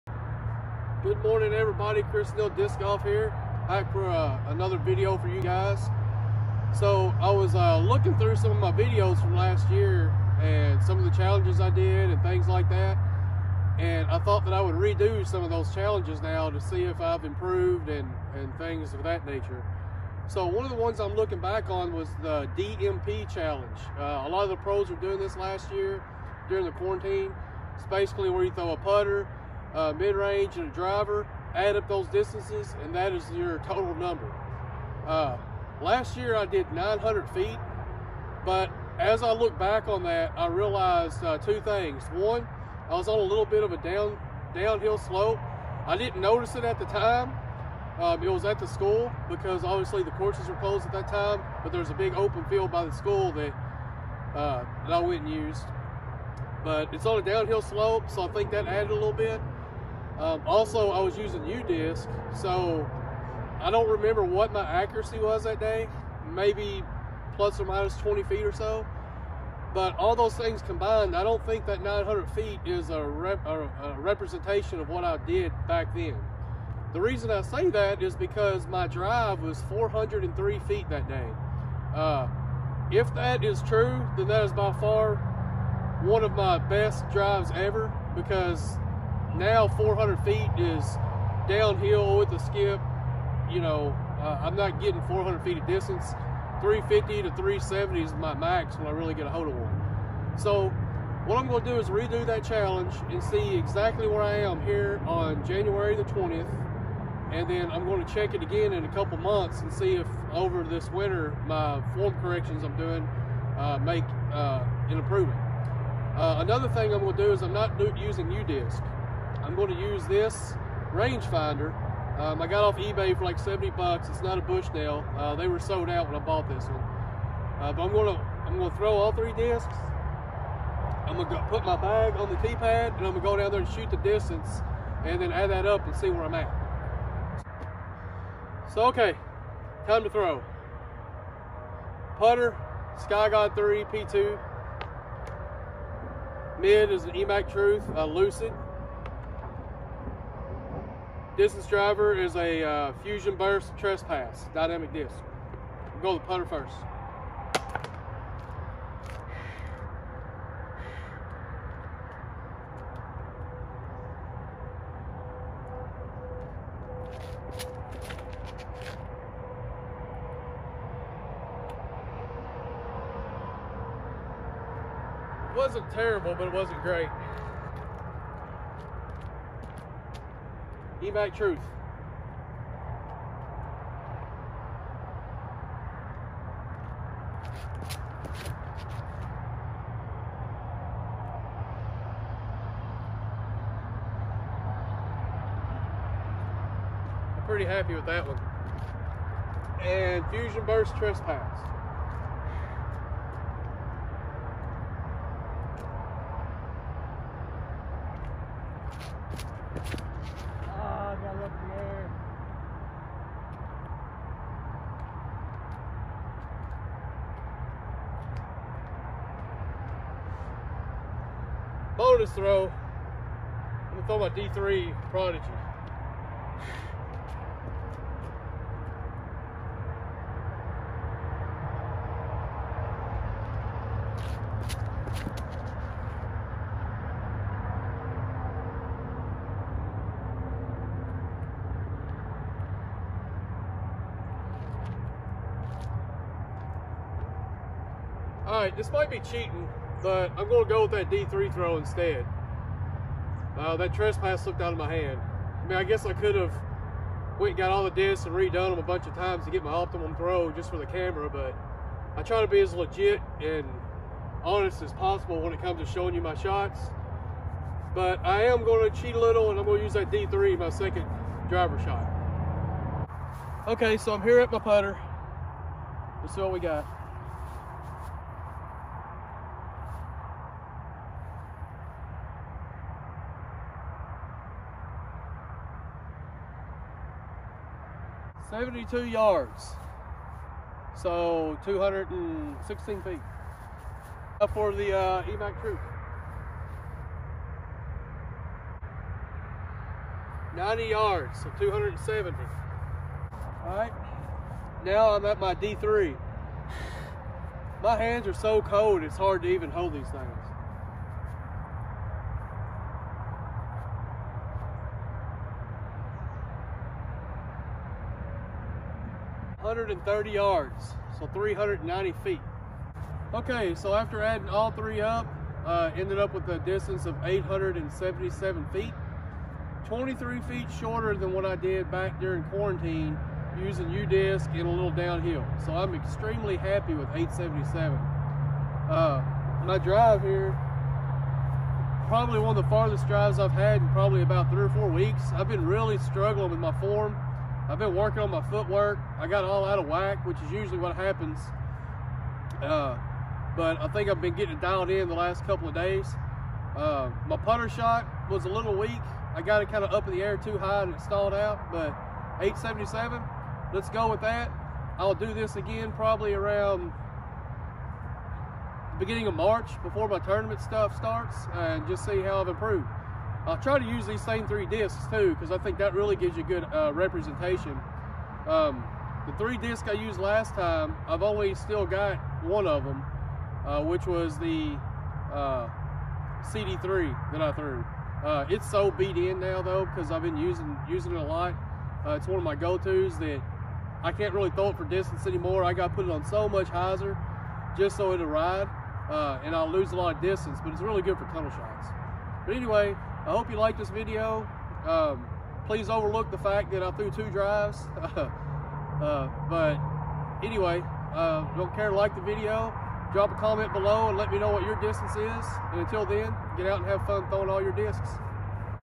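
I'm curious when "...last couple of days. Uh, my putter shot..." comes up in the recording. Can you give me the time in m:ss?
5:55.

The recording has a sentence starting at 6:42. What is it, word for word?
But anyway, I hope you like this video.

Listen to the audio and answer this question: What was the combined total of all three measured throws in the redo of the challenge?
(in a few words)
877 feet.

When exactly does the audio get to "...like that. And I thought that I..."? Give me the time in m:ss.
0:12.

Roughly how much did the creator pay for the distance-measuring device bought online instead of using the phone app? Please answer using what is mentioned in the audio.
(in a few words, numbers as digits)
70 bucks.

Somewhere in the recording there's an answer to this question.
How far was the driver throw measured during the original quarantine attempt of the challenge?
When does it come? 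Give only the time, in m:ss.
1:19.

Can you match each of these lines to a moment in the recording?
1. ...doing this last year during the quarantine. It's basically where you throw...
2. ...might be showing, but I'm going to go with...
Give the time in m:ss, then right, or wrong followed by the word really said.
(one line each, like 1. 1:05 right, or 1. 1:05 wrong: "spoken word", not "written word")
1. 0:24 right
2. 4:08 wrong: "cheating", not "showing".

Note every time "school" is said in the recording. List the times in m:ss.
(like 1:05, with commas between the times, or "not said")
0:48, 0:52.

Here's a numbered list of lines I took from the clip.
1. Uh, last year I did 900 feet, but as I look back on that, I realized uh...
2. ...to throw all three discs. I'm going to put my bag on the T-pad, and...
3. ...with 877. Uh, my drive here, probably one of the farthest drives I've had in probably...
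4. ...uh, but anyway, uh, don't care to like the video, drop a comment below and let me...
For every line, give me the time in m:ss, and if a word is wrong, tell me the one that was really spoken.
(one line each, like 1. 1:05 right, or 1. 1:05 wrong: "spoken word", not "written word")
1. 0:35 right
2. 2:08 right
3. 5:36 right
4. 6:48 right.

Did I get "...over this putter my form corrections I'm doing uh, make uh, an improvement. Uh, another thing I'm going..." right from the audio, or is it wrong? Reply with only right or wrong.
wrong.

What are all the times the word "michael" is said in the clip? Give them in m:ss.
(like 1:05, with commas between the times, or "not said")
not said.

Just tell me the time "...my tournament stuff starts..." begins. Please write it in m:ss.
6:10.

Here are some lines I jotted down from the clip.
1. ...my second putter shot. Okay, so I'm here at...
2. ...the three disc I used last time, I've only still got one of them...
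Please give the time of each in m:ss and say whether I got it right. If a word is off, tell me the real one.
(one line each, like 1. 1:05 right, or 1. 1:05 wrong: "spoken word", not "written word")
1. 4:30 wrong: "driver", not "putter"
2. 6:19 right.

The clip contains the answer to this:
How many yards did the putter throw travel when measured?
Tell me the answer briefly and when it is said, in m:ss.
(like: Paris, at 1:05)
72 yards, at 4:48.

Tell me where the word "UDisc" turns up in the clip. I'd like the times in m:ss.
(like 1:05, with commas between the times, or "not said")
1:01, 1:58, 5:33.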